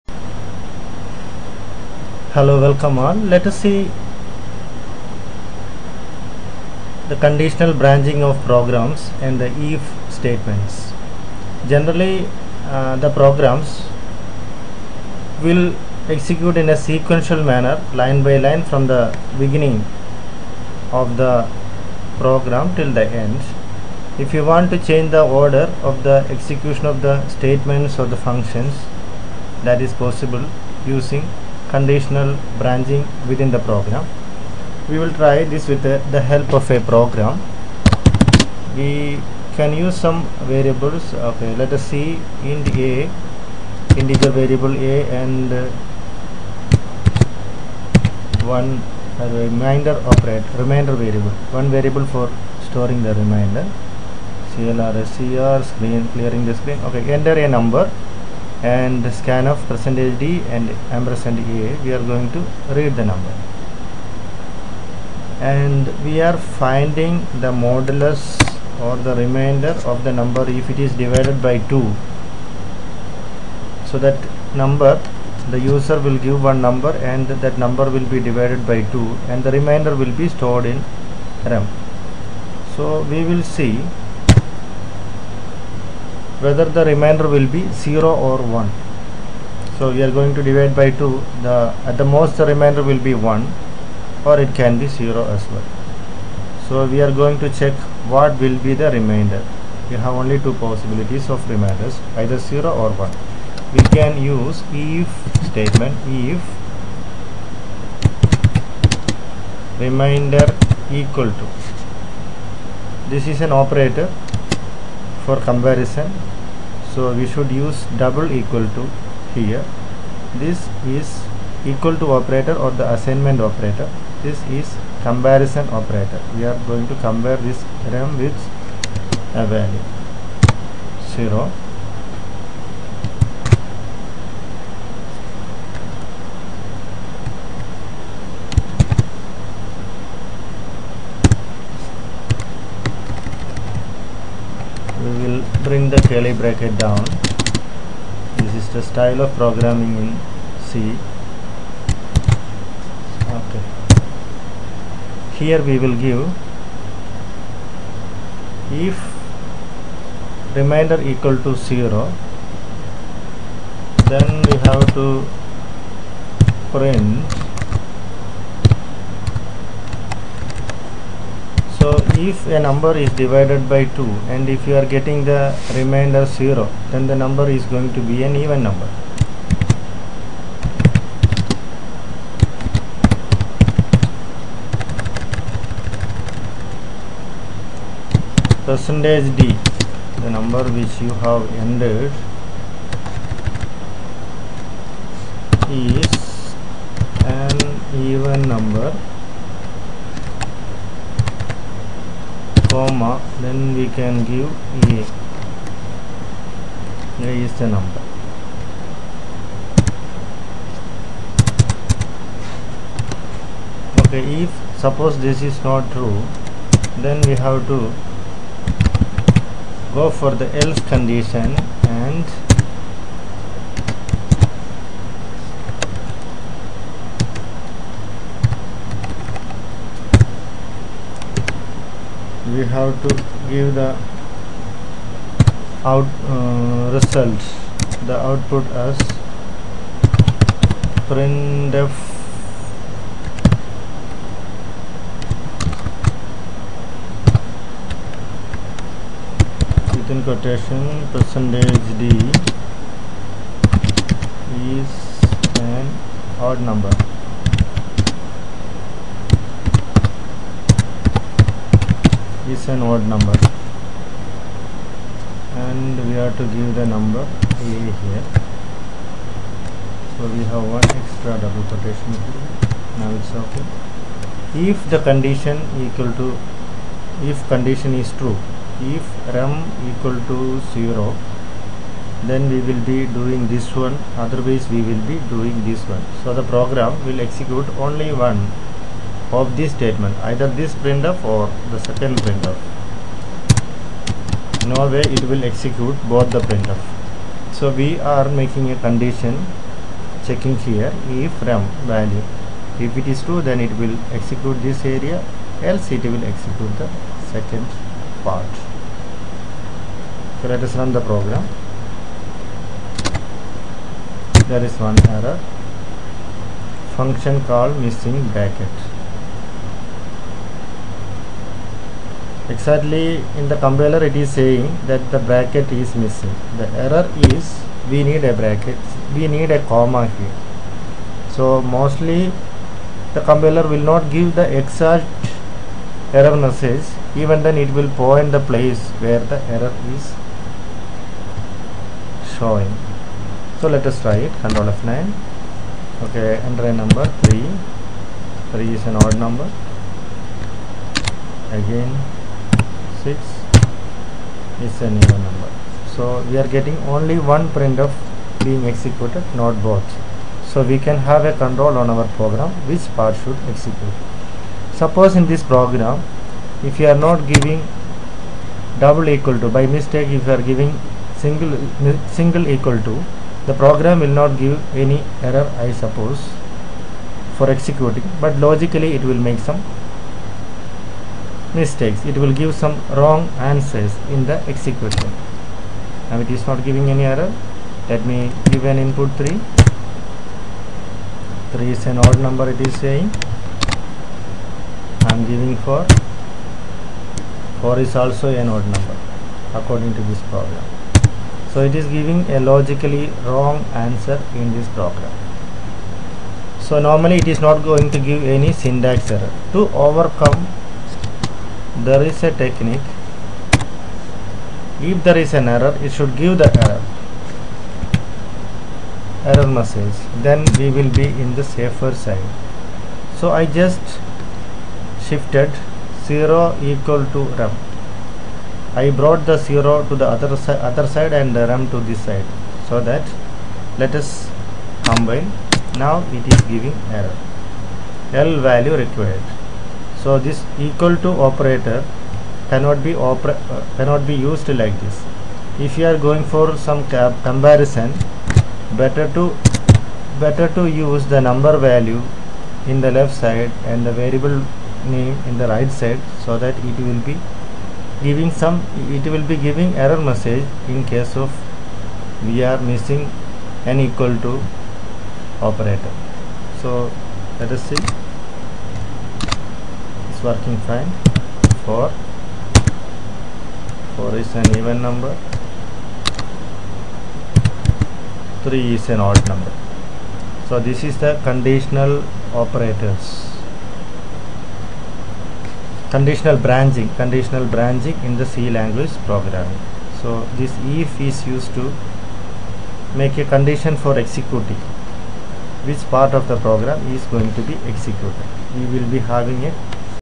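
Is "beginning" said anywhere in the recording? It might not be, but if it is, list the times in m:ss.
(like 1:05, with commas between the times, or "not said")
0:19.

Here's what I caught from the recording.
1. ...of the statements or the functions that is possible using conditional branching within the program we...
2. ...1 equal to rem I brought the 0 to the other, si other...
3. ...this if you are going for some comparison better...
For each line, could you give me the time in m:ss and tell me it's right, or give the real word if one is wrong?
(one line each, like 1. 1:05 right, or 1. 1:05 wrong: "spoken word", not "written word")
1. 0:26 right
2. 7:06 wrong: "0", not "1"
3. 7:24 right.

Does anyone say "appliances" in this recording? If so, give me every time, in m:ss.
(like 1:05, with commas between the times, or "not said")
not said.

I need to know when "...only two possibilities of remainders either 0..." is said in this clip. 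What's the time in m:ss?
1:40.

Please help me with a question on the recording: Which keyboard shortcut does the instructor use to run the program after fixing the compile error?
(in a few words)
Control F9.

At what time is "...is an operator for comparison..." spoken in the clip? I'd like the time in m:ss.
1:53.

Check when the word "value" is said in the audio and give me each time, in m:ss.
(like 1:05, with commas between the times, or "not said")
2:09, 5:01, 7:18, 7:31.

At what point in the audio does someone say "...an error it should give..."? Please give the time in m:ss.
6:55.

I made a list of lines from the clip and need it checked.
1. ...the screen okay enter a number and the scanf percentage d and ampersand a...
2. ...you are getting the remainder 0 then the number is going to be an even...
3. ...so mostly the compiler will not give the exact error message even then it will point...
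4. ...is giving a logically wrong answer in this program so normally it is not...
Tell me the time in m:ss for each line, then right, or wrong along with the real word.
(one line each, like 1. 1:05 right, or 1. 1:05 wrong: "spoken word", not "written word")
1. 0:56 right
2. 2:54 right
3. 5:31 right
4. 6:41 right.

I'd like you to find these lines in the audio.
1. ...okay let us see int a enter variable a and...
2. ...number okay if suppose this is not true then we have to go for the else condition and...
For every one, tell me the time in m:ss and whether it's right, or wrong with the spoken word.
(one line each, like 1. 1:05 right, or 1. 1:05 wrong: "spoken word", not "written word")
1. 0:41 wrong: "integer", not "enter"
2. 3:27 right.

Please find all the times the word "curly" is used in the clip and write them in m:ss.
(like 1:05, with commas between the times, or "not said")
2:26.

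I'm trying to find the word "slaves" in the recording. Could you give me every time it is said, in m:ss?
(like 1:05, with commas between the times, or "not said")
not said.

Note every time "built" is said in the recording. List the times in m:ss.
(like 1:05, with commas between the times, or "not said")
not said.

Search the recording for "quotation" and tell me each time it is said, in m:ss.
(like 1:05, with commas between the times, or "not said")
4:10, 4:31.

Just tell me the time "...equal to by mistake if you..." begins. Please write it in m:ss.
6:09.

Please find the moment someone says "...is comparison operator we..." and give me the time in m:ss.
2:04.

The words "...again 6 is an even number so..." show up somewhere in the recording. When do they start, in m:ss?
5:51.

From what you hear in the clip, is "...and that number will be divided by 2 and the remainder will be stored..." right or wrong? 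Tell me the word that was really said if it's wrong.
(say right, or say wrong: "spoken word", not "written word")
right.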